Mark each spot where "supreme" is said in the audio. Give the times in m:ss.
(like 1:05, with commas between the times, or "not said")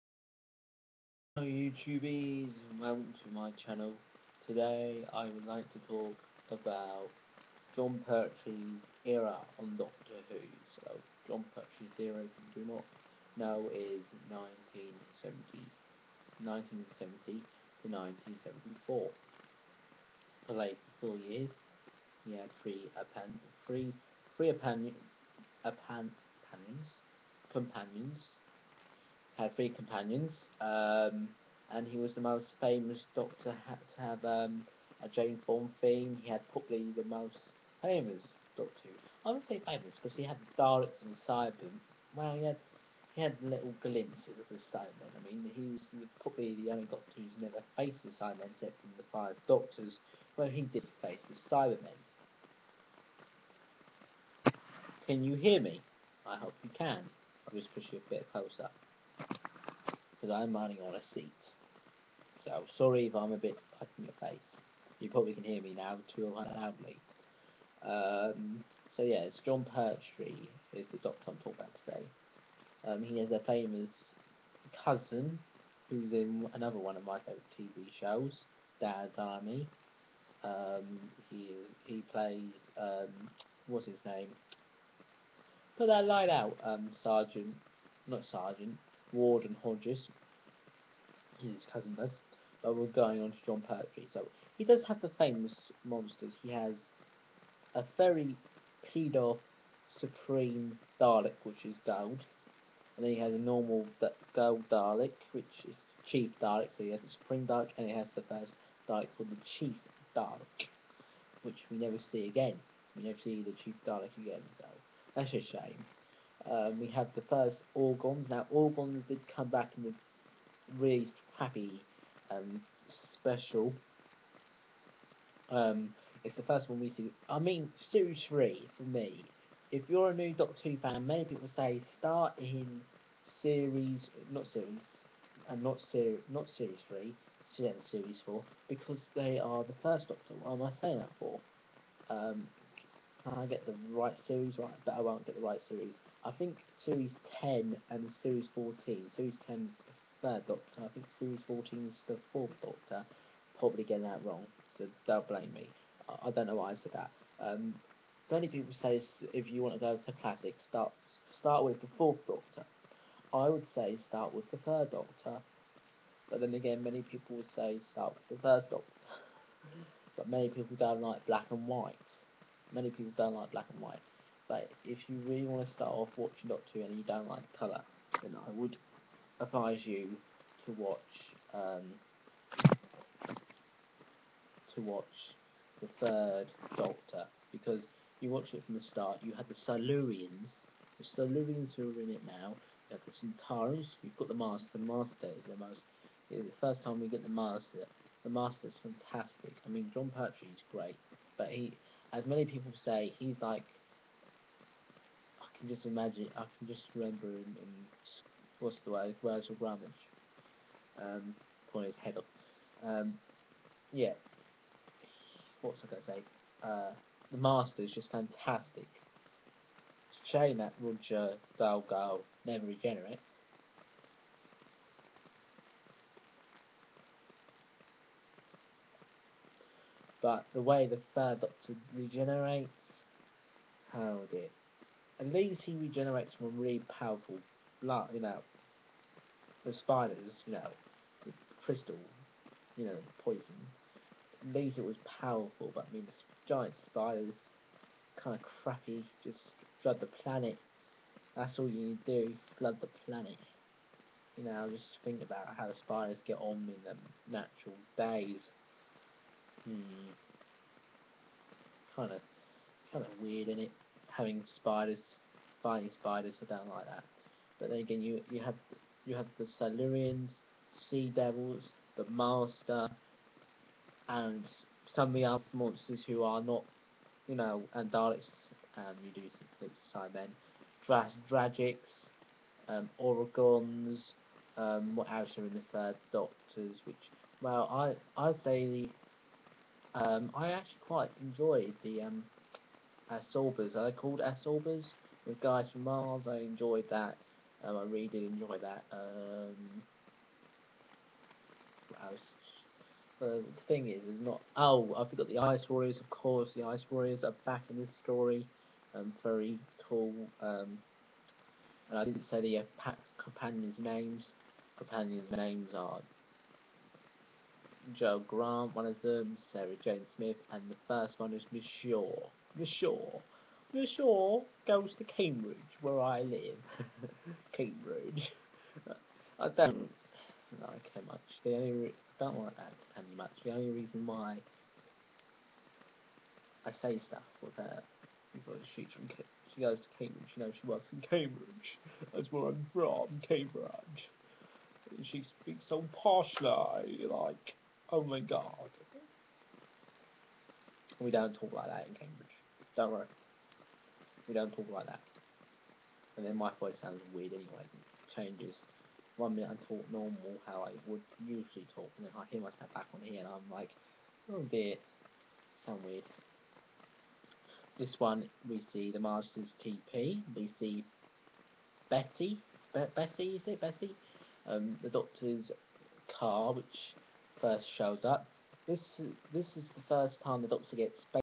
1:39, 1:47.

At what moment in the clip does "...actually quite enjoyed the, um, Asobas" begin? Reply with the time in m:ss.
4:50.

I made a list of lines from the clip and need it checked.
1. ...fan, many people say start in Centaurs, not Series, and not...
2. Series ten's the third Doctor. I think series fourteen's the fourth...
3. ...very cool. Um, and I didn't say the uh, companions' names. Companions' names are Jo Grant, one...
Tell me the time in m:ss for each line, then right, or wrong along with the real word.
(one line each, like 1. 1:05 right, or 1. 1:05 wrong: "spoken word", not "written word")
1. 2:10 wrong: "Series", not "Centaurs"
2. 2:29 right
3. 5:09 right.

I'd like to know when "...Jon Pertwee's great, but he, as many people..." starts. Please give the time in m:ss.
3:19.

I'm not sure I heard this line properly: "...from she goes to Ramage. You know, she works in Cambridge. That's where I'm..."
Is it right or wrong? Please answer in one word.
wrong.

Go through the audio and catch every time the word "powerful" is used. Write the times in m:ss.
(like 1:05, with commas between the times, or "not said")
3:56, 4:05.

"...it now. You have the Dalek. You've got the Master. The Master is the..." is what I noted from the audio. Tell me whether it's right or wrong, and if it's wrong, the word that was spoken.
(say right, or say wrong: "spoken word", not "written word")
wrong: "Centaurs", not "Dalek".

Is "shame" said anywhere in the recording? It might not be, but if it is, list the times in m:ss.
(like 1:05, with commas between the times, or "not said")
1:55, 3:40.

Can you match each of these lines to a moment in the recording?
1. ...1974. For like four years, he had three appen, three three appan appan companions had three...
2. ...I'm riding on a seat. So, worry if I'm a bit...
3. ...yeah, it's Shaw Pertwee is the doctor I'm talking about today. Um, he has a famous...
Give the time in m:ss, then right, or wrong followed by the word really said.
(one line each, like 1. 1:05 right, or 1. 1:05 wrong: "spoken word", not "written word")
1. 0:18 right
2. 1:00 wrong: "sorry", not "worry"
3. 1:09 wrong: "Jon", not "Shaw".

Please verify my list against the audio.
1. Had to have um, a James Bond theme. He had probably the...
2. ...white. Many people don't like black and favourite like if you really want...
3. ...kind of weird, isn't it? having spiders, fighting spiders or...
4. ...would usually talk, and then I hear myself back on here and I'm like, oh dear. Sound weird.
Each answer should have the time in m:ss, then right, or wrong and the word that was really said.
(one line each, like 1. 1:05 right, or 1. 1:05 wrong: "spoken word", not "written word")
1. 0:33 right
2. 2:51 wrong: "white", not "favourite"
3. 4:22 right
4. 6:00 right.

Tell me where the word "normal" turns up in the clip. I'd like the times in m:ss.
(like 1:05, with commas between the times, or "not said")
1:43, 5:59.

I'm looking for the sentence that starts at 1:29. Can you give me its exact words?
Warden Hodges, his cousin does, but we're going on to Jon Pertwee.